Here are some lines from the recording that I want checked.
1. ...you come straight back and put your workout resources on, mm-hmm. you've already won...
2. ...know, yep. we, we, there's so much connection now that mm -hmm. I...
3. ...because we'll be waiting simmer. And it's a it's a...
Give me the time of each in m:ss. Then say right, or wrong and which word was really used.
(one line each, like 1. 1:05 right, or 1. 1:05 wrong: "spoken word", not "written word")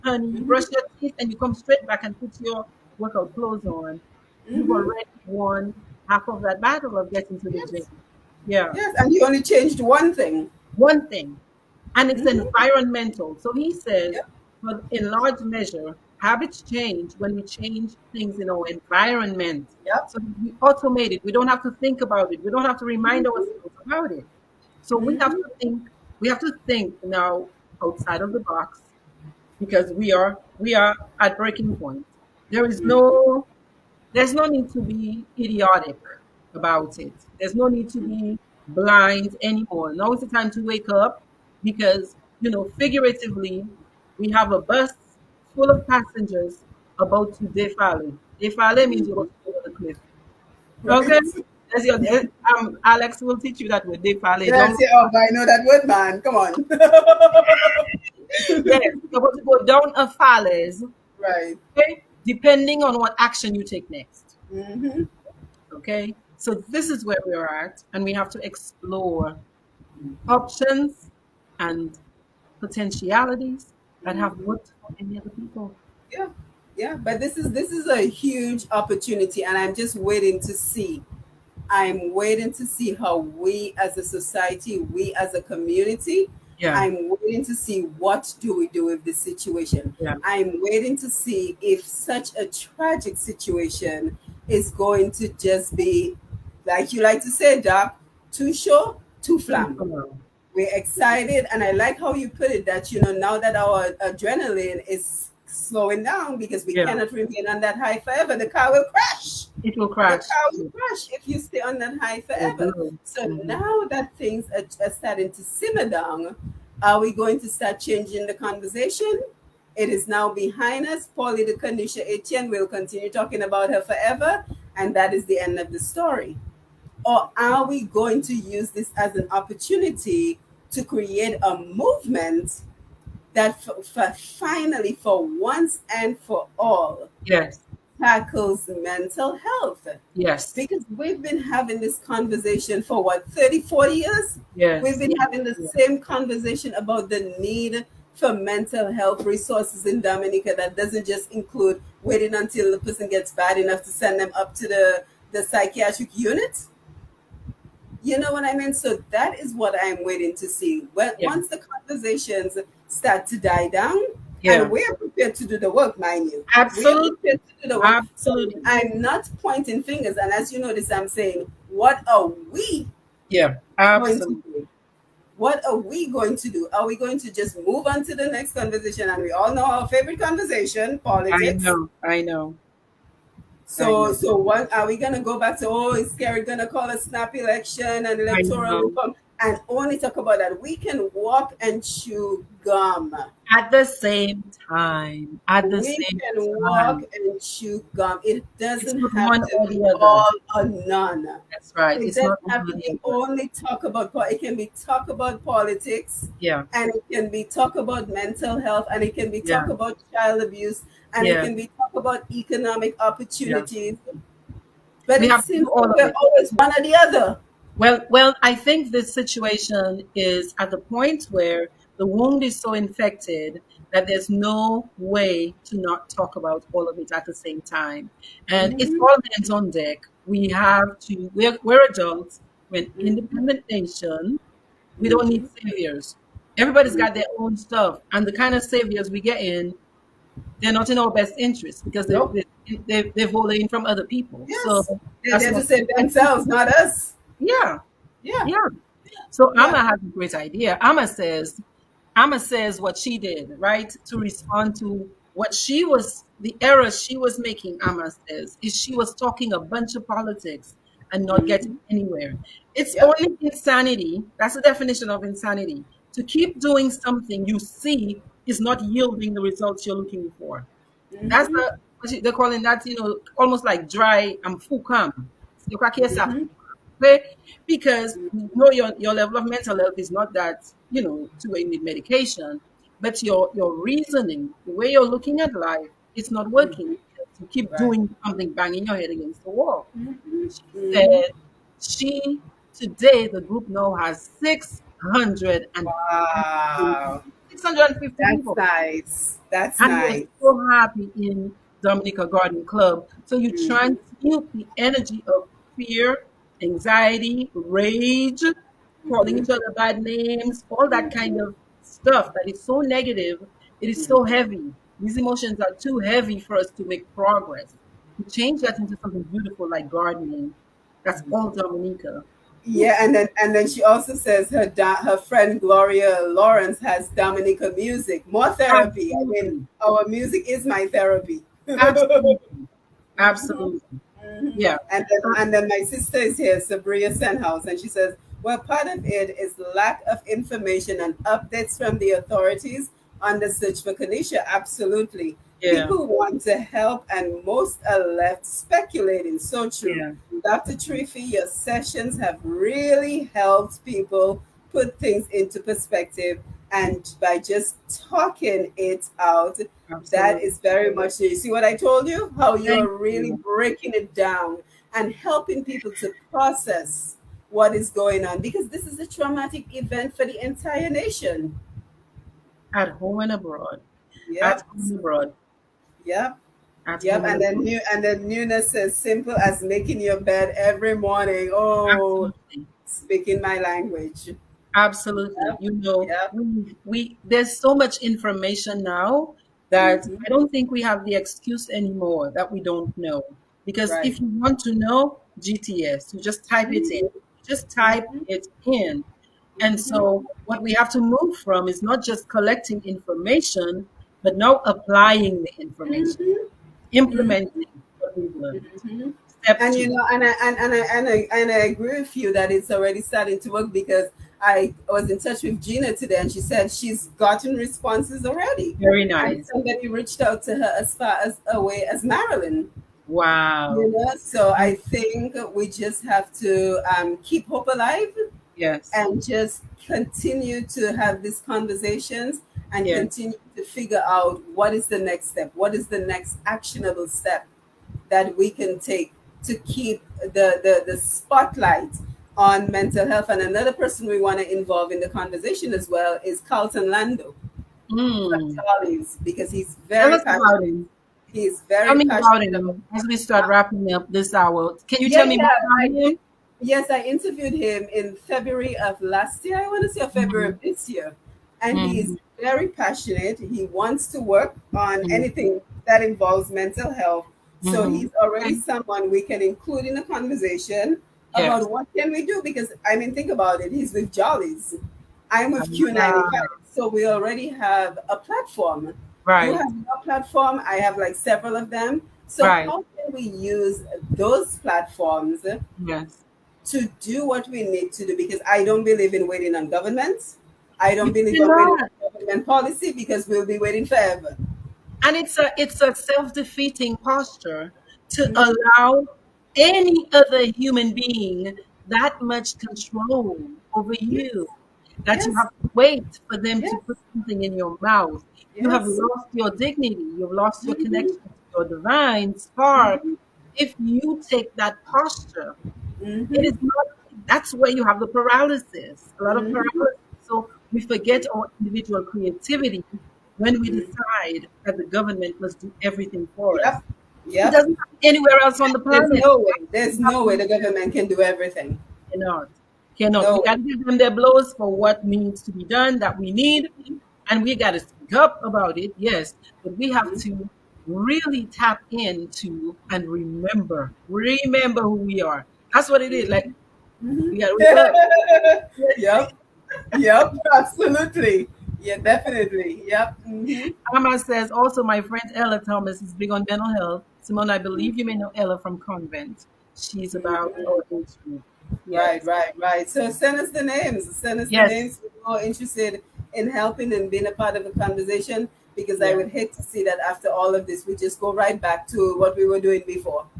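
1. 0:01 wrong: "clothes", not "resources"
2. 6:25 wrong: "information", not "connection"
3. 8:12 wrong: "forever", not "simmer".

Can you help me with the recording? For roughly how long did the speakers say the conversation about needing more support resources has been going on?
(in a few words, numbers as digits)
30, 40 years.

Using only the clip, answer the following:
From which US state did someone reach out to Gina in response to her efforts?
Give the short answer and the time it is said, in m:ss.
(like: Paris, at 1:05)
Maryland, at 7:02.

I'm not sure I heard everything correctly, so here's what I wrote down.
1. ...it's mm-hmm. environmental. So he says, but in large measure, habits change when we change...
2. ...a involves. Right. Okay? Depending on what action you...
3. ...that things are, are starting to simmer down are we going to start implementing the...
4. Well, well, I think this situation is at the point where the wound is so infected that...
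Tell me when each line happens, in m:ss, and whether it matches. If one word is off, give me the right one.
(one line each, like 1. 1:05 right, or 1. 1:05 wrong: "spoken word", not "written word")
1. 0:12 right
2. 0:59 wrong: "falles", not "involves"
3. 1:53 wrong: "changing", not "implementing"
4. 3:37 right.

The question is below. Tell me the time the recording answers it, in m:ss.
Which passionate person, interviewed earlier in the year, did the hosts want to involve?
7:26.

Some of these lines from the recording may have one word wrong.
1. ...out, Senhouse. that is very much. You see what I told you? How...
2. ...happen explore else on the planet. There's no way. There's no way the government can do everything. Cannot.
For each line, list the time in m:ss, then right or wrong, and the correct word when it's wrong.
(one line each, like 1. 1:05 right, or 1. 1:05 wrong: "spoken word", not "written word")
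1. 5:59 wrong: "Absolutely", not "Senhouse"
2. 8:47 wrong: "anywhere", not "explore".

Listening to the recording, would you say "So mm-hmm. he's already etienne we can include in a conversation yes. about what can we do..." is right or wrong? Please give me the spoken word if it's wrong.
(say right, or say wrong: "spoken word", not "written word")
wrong: "someone", not "etienne".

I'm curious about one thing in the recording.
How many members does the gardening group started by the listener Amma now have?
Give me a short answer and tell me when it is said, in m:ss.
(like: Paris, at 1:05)
650, at 4:57.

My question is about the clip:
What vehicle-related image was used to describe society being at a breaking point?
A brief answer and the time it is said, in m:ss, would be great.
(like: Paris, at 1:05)
bus full of passengers, at 0:44.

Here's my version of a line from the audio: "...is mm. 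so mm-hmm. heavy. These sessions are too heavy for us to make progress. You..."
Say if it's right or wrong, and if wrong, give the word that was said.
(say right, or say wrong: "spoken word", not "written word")
wrong: "emotions", not "sessions".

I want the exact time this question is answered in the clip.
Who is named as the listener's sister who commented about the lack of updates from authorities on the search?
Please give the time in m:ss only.
5:36.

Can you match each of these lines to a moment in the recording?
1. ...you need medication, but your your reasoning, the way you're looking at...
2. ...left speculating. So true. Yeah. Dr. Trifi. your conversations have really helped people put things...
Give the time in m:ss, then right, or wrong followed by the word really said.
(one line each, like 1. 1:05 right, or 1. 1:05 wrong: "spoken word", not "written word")
1. 4:41 right
2. 5:48 wrong: "sessions", not "conversations".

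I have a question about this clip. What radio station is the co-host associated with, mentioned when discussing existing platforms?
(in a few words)
Q95.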